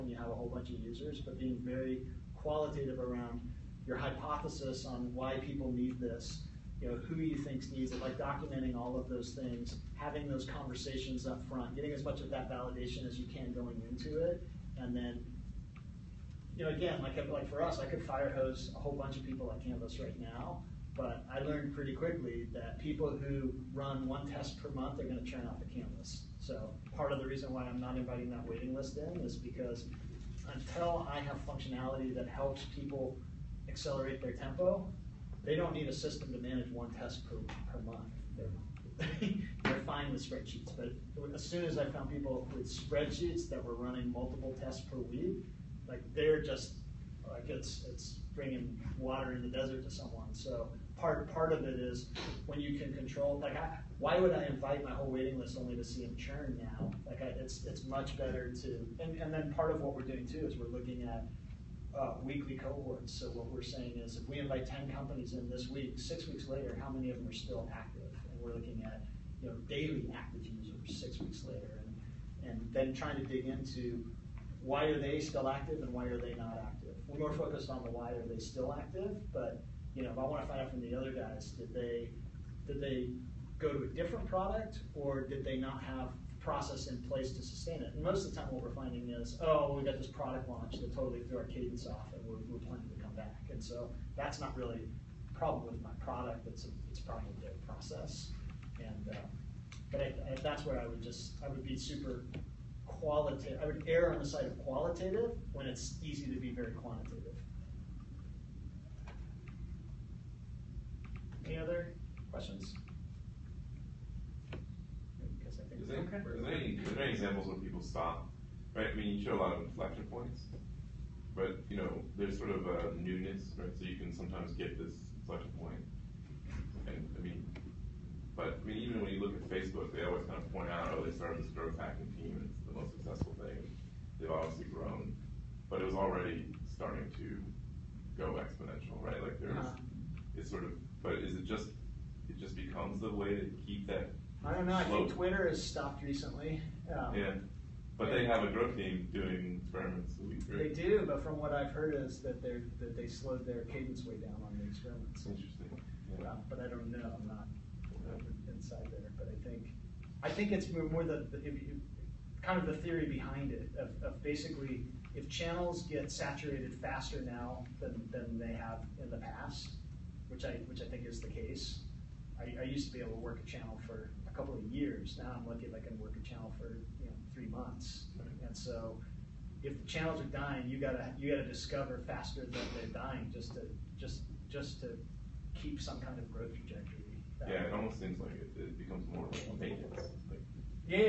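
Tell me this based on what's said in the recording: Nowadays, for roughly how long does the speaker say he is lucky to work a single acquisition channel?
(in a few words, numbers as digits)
3 months.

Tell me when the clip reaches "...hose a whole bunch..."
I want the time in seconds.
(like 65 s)
18 s.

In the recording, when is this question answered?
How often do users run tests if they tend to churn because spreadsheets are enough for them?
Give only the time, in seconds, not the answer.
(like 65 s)
24 s.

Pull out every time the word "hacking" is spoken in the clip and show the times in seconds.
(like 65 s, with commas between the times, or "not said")
131 s.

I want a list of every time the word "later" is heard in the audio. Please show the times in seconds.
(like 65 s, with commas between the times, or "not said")
66 s, 71 s.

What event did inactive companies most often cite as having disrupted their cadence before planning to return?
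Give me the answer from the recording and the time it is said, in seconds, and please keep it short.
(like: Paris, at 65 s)
product launch, at 90 s.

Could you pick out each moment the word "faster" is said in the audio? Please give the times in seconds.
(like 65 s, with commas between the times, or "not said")
166 s, 182 s.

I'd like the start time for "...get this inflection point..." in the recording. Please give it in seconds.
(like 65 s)
124 s.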